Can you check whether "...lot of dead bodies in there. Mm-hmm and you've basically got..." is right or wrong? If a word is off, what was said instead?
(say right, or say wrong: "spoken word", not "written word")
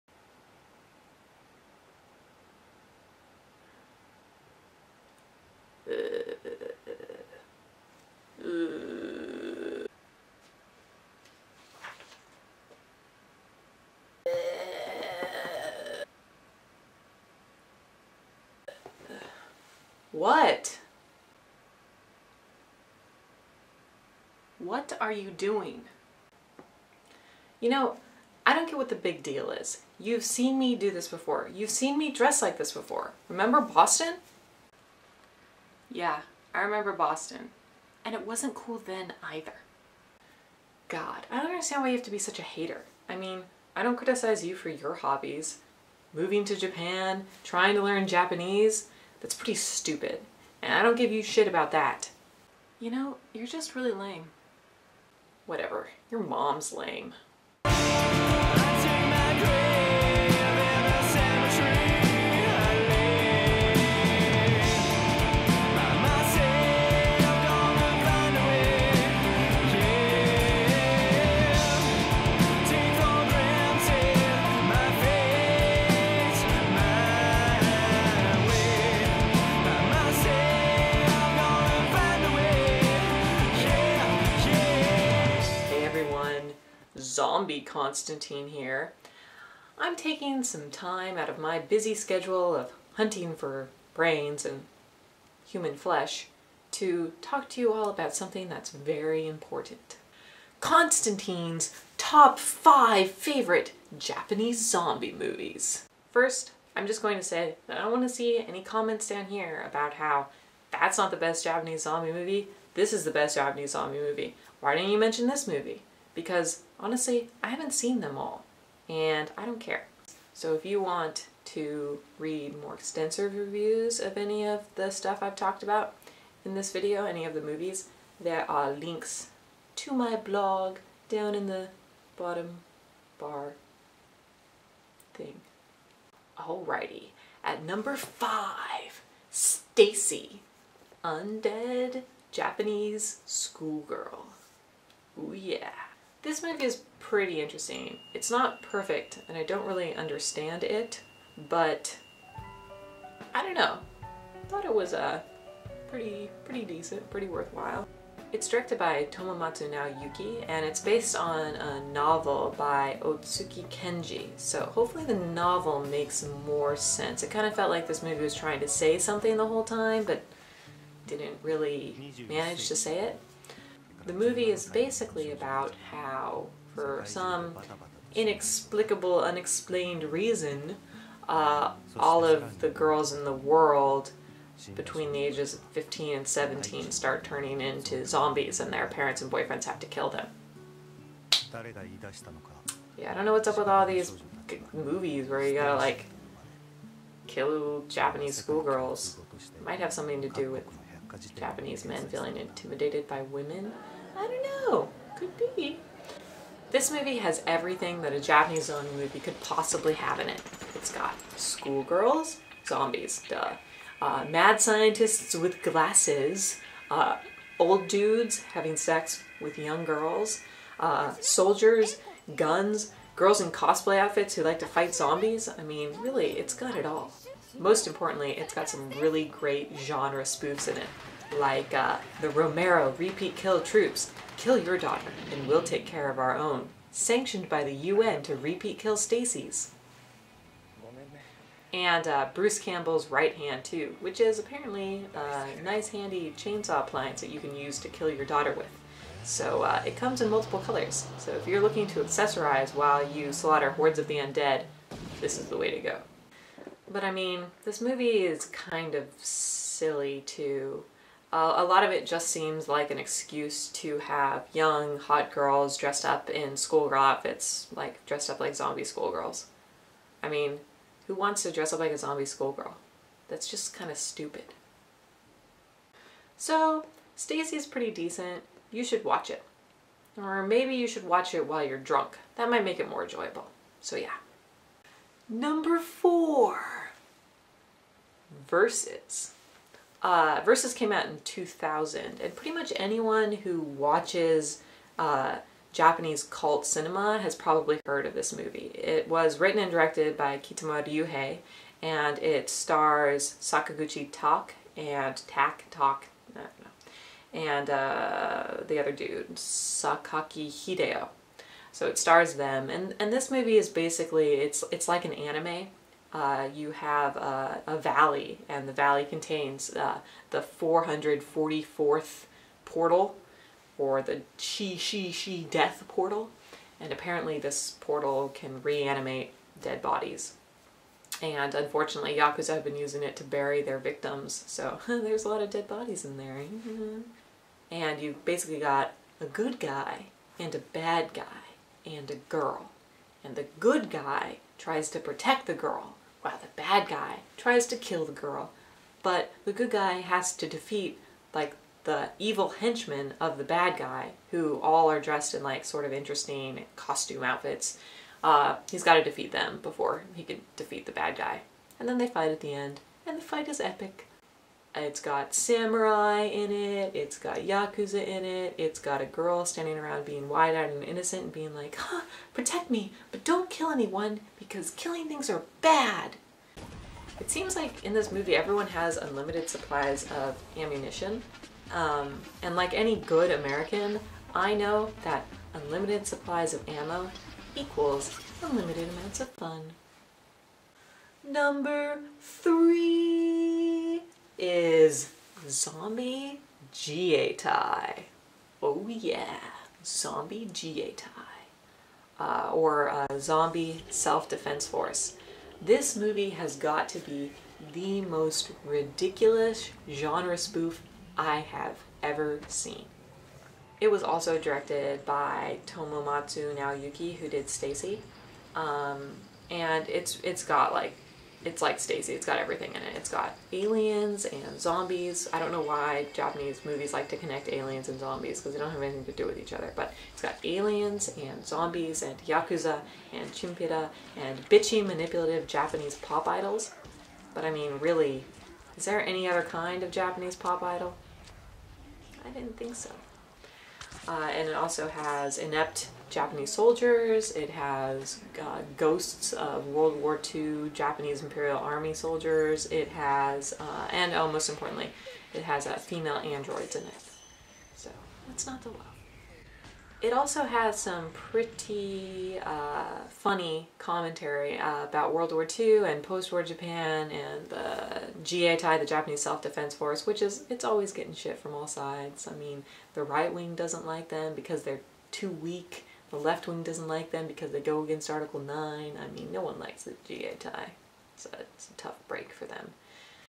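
right.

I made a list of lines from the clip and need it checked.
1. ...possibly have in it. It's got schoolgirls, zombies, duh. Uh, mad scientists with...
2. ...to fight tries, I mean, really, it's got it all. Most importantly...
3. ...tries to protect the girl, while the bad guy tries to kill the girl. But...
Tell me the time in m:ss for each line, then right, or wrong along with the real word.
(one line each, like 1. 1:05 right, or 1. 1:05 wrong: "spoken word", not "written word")
1. 3:29 right
2. 3:44 wrong: "zombies", not "tries"
3. 5:44 right.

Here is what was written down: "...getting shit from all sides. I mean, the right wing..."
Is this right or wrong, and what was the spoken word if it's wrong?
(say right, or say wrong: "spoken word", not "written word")
right.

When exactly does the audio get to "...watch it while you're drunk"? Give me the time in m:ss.
4:41.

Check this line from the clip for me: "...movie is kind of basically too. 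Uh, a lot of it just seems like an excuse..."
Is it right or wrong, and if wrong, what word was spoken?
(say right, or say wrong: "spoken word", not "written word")
wrong: "silly", not "basically".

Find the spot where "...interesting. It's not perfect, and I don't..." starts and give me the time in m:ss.
2:27.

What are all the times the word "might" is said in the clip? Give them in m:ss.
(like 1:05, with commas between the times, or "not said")
3:19, 4:42.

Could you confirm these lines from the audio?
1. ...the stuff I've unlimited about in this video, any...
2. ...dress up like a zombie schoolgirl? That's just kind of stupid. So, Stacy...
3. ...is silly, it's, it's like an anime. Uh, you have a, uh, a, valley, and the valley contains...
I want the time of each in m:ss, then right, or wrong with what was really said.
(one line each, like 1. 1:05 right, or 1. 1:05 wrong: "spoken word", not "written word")
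1. 2:04 wrong: "talked", not "unlimited"
2. 4:31 right
3. 5:13 wrong: "basically", not "silly".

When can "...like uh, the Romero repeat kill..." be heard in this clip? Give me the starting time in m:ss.
3:51.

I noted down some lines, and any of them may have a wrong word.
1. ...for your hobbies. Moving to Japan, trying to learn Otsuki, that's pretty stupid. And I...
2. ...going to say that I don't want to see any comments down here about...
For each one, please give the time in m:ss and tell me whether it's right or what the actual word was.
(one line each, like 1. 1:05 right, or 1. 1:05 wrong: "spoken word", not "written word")
1. 0:44 wrong: "Japanese", not "Otsuki"
2. 1:47 right.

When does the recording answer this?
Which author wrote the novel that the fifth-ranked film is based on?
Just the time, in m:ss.
2:43.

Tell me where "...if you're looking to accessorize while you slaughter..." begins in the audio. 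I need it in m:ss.
4:11.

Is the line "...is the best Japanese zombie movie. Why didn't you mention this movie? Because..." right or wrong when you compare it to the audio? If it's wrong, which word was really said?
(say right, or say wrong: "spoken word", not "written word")
right.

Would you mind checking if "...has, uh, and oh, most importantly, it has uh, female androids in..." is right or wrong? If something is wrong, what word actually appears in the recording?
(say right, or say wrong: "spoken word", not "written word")
right.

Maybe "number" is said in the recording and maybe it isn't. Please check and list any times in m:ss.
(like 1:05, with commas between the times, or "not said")
2:17, 4:45, 6:31.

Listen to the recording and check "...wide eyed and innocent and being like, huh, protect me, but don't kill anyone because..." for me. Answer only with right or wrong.
right.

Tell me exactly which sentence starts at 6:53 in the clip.
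It was also directed by Tomomatsu Naoyuki, who did Stacy.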